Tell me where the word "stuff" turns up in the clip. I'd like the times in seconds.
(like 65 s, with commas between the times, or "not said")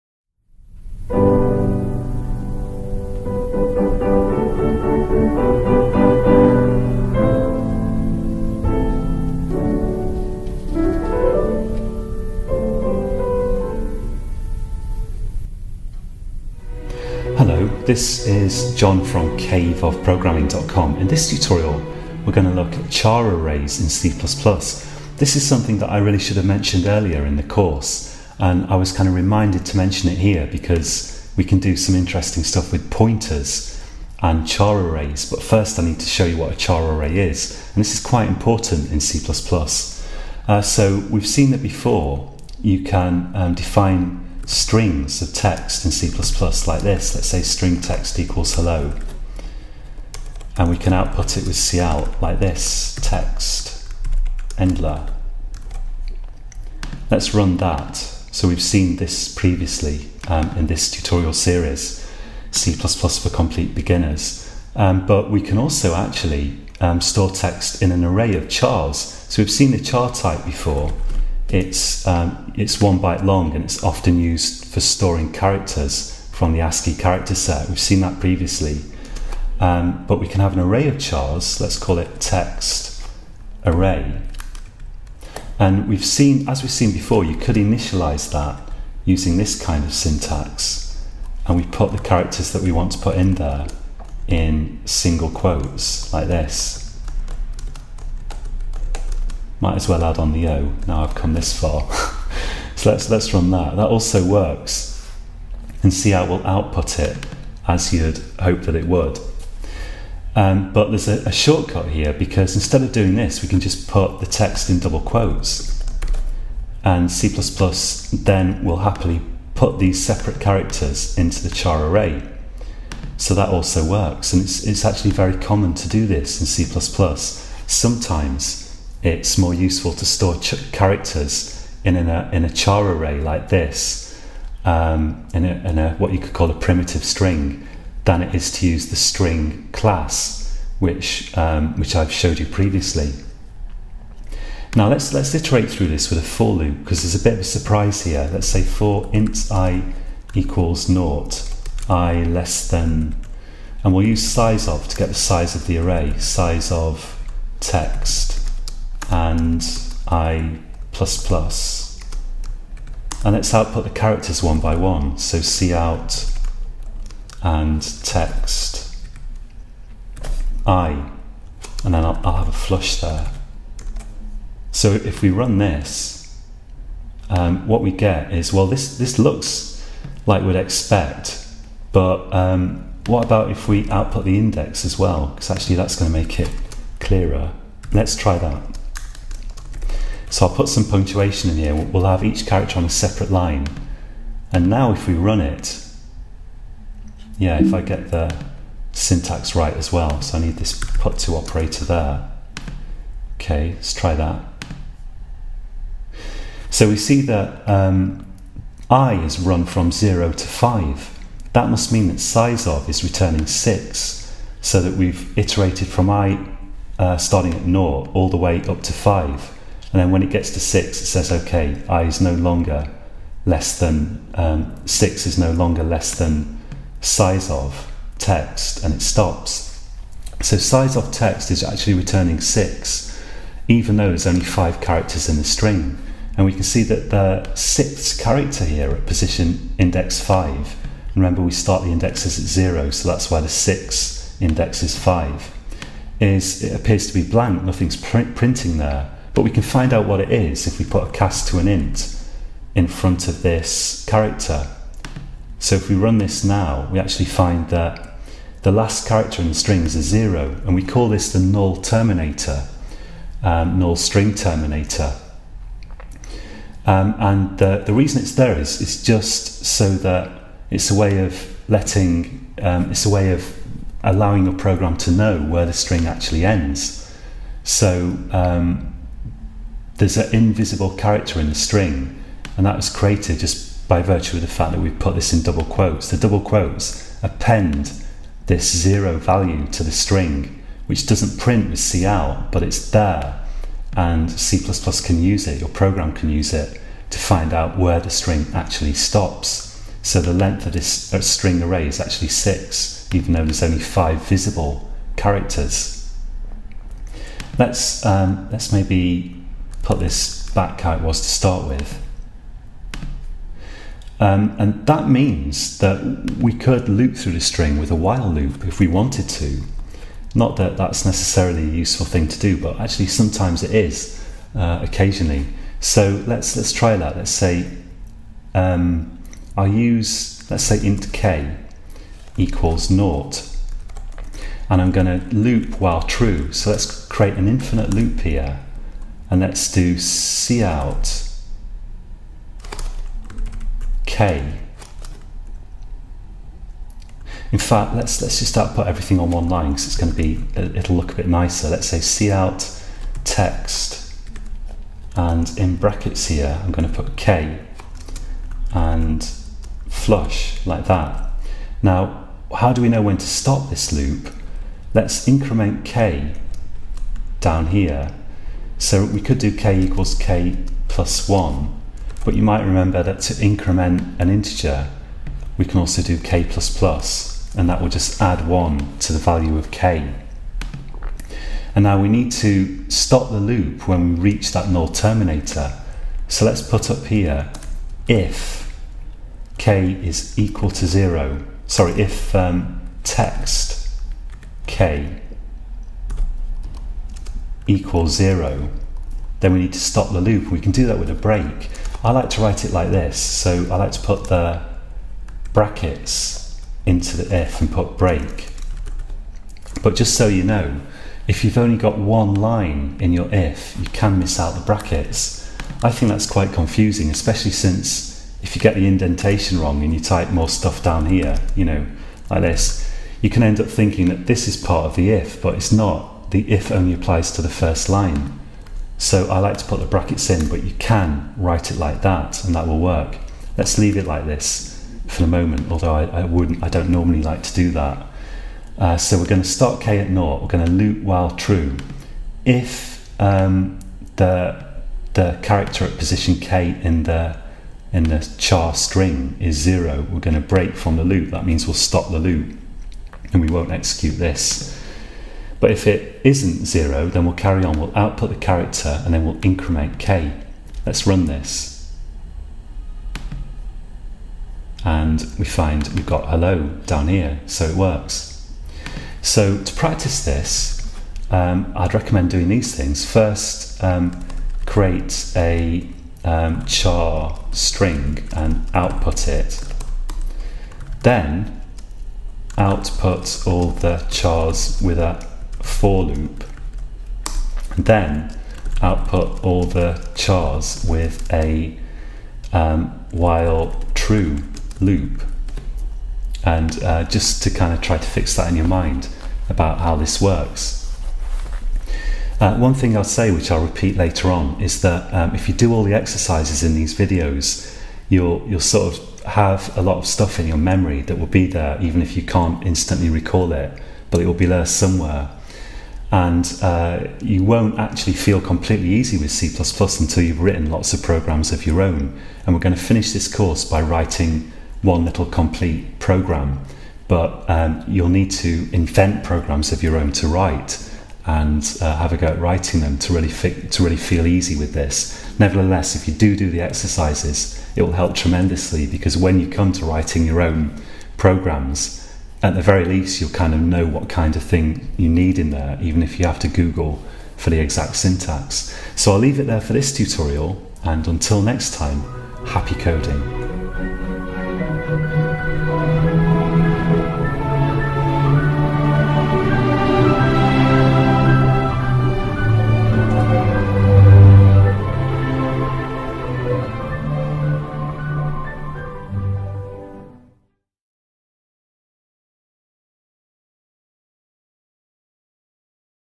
32 s, 420 s, 510 s.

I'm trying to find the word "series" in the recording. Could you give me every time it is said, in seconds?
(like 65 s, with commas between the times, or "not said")
61 s.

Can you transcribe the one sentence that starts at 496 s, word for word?
And uh, just to kind of try to fix that in your mind about how this works.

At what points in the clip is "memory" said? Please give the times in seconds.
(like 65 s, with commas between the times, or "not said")
510 s.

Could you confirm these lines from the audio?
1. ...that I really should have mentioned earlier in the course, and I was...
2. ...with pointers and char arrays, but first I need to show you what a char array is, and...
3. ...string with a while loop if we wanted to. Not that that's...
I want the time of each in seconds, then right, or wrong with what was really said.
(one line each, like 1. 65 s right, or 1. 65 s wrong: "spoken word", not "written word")
1. 25 s right
2. 32 s right
3. 317 s right.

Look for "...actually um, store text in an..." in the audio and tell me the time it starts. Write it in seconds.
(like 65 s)
65 s.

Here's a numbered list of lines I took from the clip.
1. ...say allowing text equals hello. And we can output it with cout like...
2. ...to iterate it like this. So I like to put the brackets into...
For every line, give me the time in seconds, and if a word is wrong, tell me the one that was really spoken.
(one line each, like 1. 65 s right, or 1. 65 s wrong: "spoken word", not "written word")
1. 47 s wrong: "string", not "allowing"
2. 402 s wrong: "write", not "iterate".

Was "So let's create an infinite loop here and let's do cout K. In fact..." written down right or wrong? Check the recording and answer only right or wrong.
right.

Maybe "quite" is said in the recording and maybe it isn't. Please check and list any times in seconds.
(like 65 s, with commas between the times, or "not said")
38 s, 416 s.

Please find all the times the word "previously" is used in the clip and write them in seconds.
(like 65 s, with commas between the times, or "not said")
59 s, 78 s, 142 s.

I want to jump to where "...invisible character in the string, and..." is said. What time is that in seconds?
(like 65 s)
280 s.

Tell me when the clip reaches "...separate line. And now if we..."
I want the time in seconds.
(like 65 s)
192 s.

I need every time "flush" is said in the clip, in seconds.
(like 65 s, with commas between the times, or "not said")
172 s, 359 s.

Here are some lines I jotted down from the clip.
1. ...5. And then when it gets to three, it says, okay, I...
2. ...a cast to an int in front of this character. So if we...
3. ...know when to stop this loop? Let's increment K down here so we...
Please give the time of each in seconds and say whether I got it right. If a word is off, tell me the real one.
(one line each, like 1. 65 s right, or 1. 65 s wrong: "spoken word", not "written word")
1. 218 s wrong: "six", not "three"
2. 251 s right
3. 362 s right.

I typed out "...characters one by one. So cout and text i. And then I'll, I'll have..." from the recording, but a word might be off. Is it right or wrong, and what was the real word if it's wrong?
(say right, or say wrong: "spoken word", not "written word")
right.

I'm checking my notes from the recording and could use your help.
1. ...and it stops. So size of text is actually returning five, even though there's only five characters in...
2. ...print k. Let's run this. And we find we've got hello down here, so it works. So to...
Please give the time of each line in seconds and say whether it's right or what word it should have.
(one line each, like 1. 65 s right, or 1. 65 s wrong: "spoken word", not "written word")
1. 228 s wrong: "six", not "five"
2. 459 s wrong: "increment", not "print".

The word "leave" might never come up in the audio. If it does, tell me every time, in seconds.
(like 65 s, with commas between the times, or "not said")
433 s, 549 s.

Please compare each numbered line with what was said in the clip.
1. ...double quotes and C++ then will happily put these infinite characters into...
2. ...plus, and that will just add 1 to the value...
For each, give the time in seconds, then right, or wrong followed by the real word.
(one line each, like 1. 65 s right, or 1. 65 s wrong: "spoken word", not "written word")
1. 114 s wrong: "separate", not "infinite"
2. 376 s right.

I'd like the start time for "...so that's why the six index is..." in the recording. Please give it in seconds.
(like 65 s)
242 s.